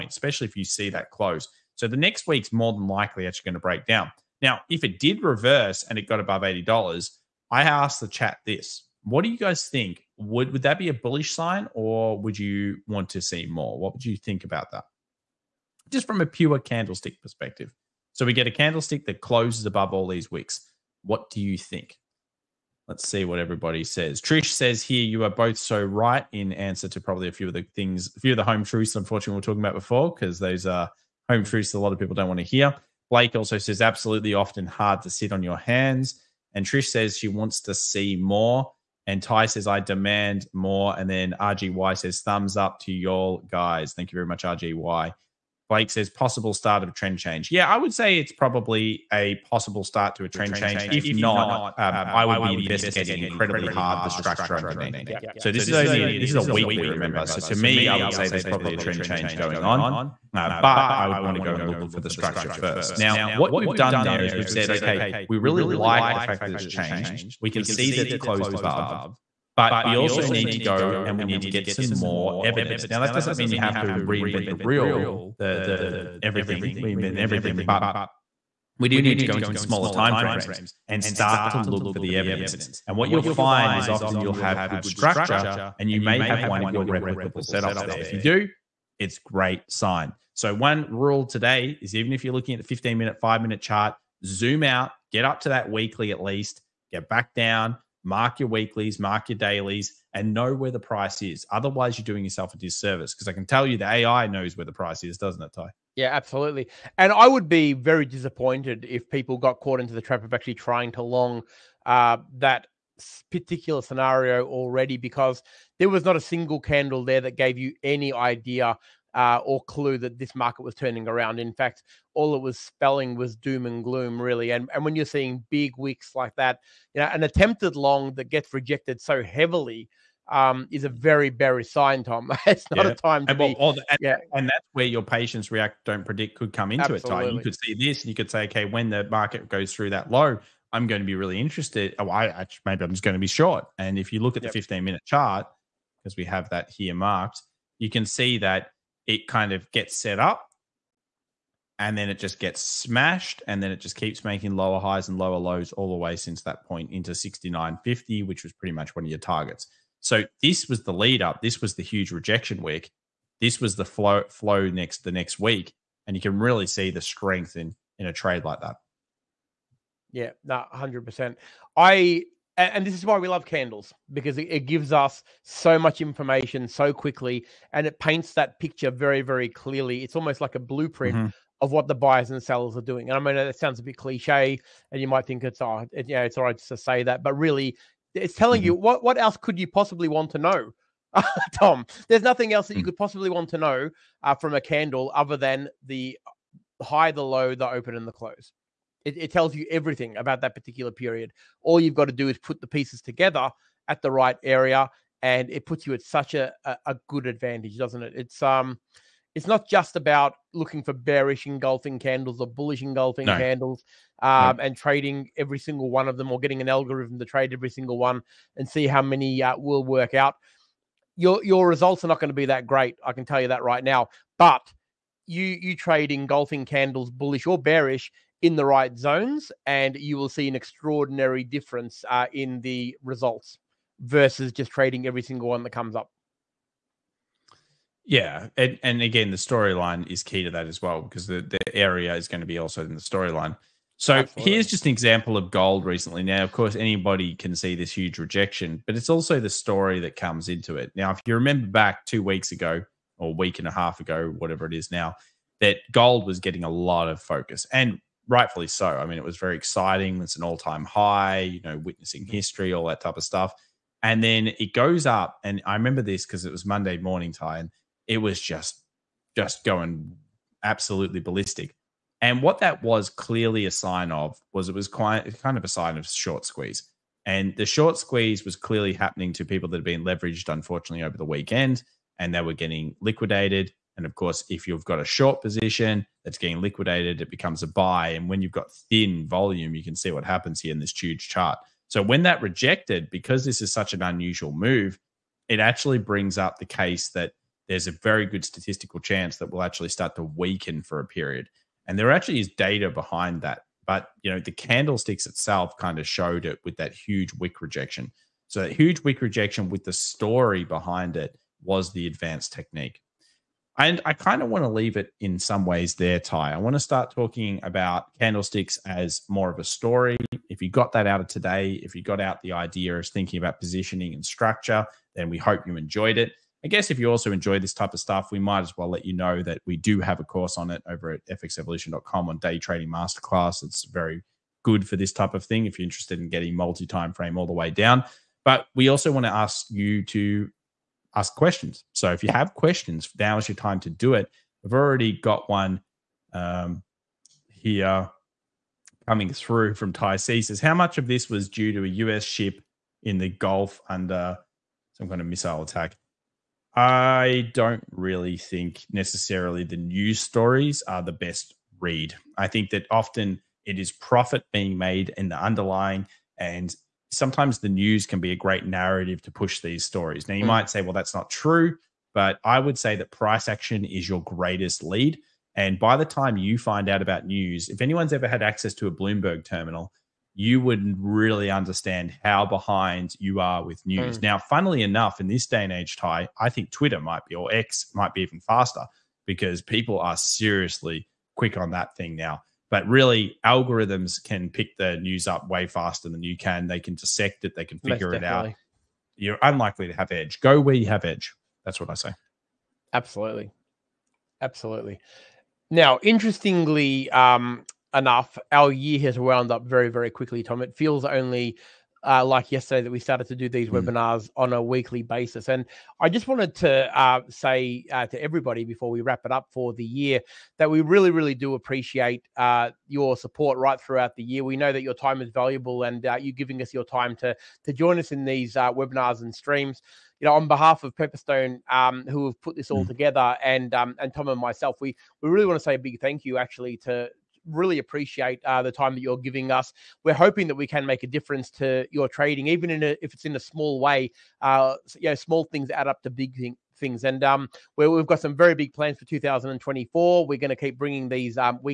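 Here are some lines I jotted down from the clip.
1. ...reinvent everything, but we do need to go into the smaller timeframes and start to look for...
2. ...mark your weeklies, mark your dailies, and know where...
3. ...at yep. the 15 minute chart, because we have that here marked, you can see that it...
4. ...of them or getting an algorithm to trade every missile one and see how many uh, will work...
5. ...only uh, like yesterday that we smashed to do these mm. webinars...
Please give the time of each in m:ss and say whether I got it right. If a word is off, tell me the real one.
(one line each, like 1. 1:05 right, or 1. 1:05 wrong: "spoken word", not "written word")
1. 1:16 right
2. 1:38 right
3. 2:24 right
4. 3:36 wrong: "single", not "missile"
5. 6:51 wrong: "started", not "smashed".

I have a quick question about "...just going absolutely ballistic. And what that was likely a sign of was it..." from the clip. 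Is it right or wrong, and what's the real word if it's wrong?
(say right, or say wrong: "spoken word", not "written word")
wrong: "clearly", not "likely".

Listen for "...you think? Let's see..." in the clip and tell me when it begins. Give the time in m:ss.
0:21.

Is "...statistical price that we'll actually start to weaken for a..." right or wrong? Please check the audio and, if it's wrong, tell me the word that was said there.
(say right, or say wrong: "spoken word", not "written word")
wrong: "chance", not "price".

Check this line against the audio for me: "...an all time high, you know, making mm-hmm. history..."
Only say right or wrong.
wrong.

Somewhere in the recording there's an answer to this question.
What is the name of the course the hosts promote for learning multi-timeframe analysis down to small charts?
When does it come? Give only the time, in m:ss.
5:32.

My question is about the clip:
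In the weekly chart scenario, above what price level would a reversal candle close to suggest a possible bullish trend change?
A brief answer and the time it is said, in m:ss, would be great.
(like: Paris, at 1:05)
$80, at 0:06.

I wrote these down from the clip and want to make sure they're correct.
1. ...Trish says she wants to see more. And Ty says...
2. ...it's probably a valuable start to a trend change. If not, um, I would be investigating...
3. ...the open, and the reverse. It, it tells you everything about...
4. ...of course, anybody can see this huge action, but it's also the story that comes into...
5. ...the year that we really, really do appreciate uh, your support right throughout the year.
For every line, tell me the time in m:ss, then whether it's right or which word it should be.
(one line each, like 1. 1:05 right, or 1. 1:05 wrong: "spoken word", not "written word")
1. 0:36 right
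2. 0:48 wrong: "possible", not "valuable"
3. 3:17 wrong: "close", not "reverse"
4. 4:06 wrong: "rejection", not "action"
5. 6:59 right.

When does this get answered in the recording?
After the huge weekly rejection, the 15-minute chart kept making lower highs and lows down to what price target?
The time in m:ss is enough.
2:37.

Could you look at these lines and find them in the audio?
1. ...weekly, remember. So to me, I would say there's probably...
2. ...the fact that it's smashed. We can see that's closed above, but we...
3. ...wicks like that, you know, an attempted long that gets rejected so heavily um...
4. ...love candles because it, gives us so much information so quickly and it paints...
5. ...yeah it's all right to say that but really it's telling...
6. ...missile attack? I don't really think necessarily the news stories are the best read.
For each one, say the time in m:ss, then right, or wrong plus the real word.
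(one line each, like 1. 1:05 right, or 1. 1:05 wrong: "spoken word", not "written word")
1. 0:56 right
2. 1:06 wrong: "changed", not "smashed"
3. 2:05 right
4. 2:53 right
5. 3:06 right
6. 5:55 right.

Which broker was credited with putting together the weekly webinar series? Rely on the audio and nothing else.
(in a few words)
Pepperstone.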